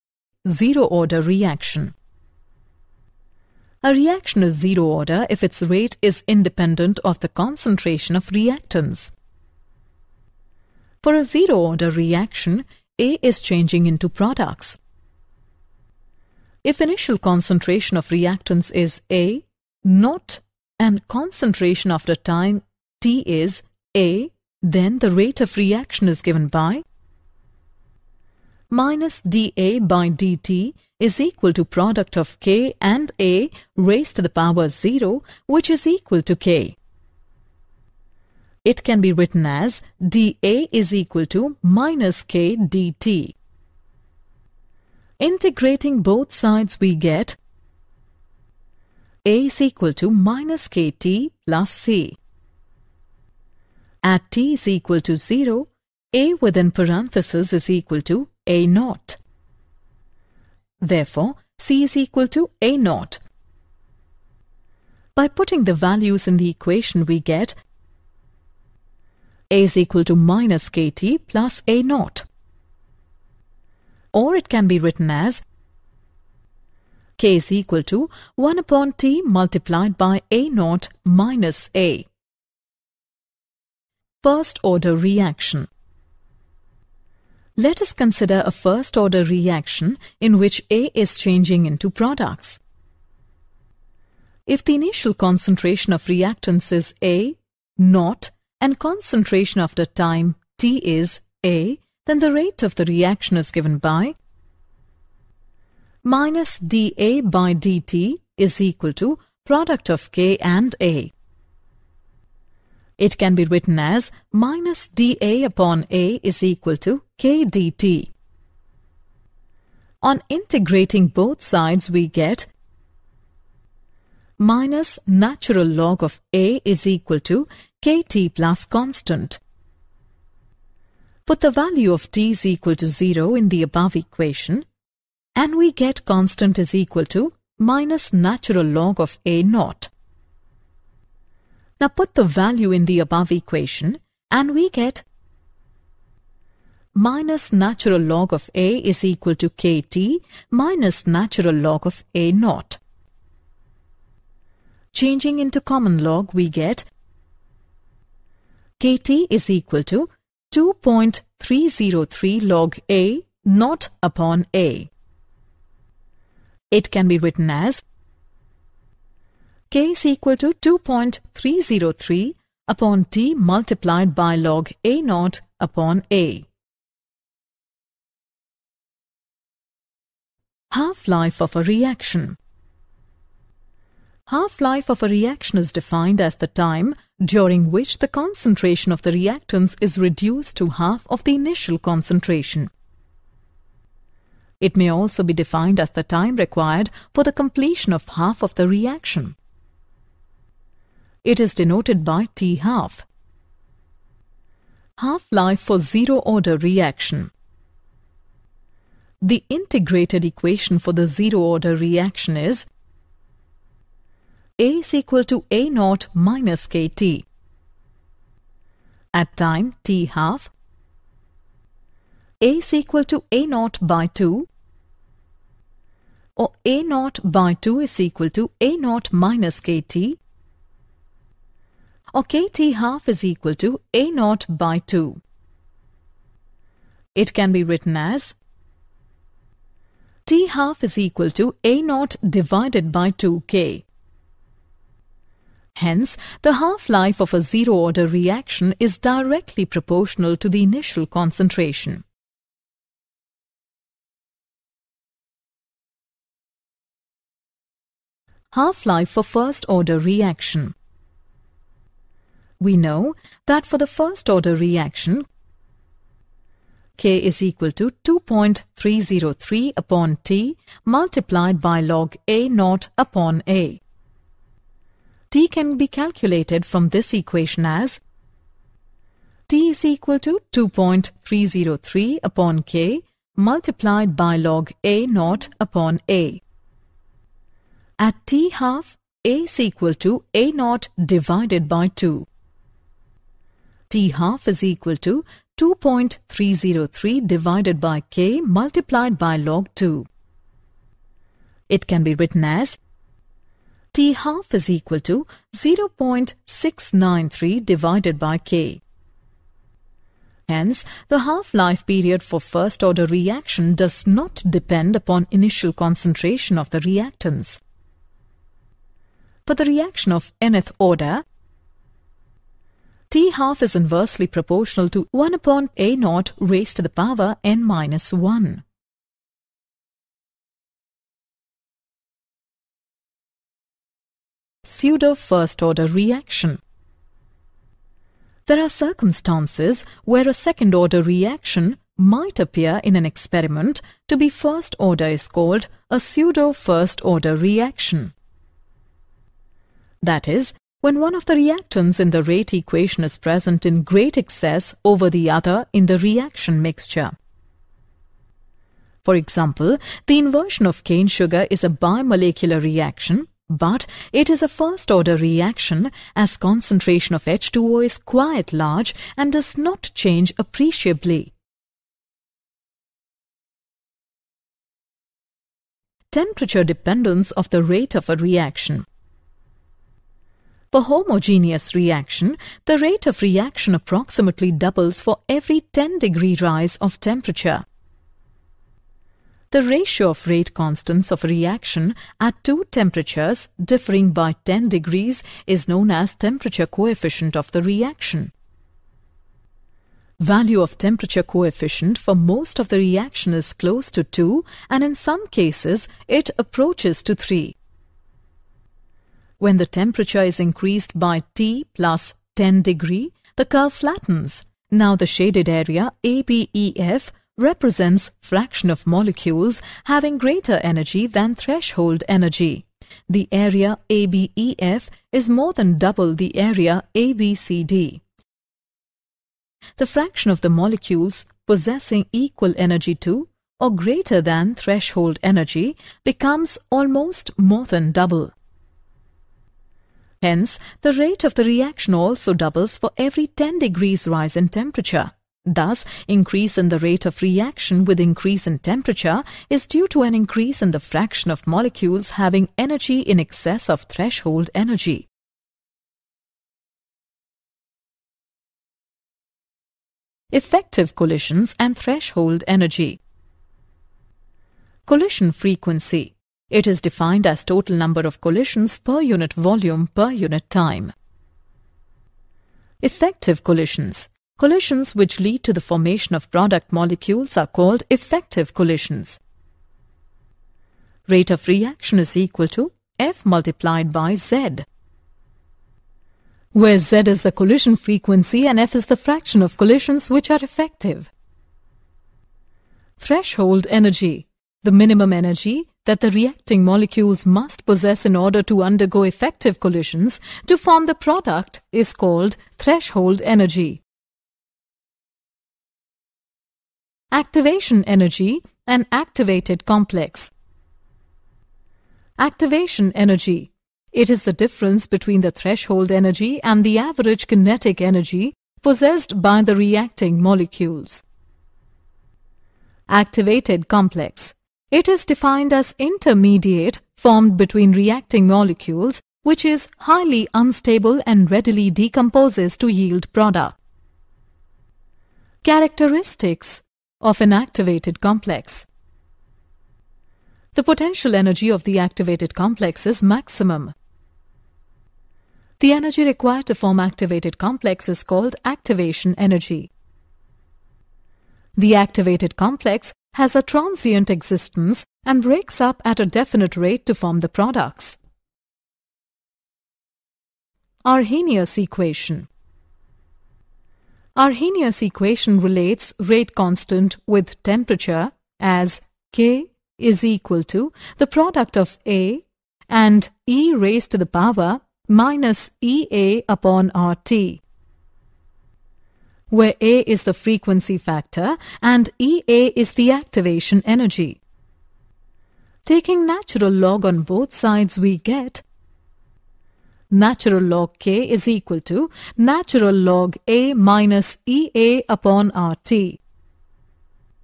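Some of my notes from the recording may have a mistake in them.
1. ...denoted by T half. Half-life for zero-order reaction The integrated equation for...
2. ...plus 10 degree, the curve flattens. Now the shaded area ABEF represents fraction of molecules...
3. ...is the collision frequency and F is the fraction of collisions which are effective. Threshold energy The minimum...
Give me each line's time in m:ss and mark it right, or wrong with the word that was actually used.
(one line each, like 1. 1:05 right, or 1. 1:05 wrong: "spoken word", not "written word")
1. 3:21 right
2. 6:51 right
3. 8:07 right.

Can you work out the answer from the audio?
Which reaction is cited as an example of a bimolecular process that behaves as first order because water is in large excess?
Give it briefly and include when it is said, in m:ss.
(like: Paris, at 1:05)
inversion of cane sugar, at 6:00.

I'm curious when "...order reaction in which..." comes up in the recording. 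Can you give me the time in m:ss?
1:28.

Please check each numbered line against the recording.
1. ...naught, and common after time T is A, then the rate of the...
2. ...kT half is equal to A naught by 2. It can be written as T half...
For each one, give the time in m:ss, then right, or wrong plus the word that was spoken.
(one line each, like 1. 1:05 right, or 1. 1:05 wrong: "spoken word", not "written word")
1. 1:37 wrong: "concentration", not "common"
2. 3:52 right.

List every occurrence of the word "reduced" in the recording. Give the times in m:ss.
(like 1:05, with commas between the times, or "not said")
3:09.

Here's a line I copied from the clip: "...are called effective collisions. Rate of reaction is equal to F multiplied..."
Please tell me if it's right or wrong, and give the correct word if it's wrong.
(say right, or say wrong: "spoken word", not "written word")
right.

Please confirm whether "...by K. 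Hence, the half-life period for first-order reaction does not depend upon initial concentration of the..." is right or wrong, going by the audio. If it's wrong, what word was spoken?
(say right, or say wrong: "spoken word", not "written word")
right.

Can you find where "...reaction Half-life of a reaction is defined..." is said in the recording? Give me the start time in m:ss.
3:01.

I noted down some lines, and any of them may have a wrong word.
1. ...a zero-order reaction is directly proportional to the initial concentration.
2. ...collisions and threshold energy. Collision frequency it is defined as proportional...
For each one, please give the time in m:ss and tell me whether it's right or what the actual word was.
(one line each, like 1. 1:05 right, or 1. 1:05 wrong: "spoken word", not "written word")
1. 4:07 right
2. 7:40 wrong: "total", not "proportional".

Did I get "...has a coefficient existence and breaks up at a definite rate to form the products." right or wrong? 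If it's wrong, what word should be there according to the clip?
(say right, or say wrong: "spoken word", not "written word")
wrong: "transient", not "coefficient".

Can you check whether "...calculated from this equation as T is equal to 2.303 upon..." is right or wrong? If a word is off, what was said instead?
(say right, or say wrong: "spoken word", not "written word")
right.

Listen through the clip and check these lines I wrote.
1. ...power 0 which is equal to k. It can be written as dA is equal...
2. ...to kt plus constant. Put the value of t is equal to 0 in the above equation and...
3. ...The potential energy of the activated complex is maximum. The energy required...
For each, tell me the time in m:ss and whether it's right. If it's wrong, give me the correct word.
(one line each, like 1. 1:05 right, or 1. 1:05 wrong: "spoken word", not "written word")
1. 0:34 right
2. 2:07 right
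3. 9:00 right.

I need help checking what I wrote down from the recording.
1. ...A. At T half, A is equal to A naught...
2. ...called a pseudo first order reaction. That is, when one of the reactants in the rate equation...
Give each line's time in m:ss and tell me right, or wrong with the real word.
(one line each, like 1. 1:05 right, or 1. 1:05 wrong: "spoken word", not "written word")
1. 4:46 right
2. 5:45 right.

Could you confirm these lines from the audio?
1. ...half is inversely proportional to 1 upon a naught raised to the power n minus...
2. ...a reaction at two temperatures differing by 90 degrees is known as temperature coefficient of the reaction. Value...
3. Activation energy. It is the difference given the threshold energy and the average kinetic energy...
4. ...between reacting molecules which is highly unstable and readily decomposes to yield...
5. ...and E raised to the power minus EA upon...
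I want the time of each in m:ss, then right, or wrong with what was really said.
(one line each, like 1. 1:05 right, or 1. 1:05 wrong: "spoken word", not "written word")
1. 5:23 right
2. 6:31 wrong: "10", not "90"
3. 8:32 wrong: "between", not "given"
4. 8:47 right
5. 9:32 right.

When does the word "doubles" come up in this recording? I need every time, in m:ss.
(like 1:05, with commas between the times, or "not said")
6:24, 7:05, 7:17, 7:22.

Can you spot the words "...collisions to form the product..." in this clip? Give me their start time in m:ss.
8:19.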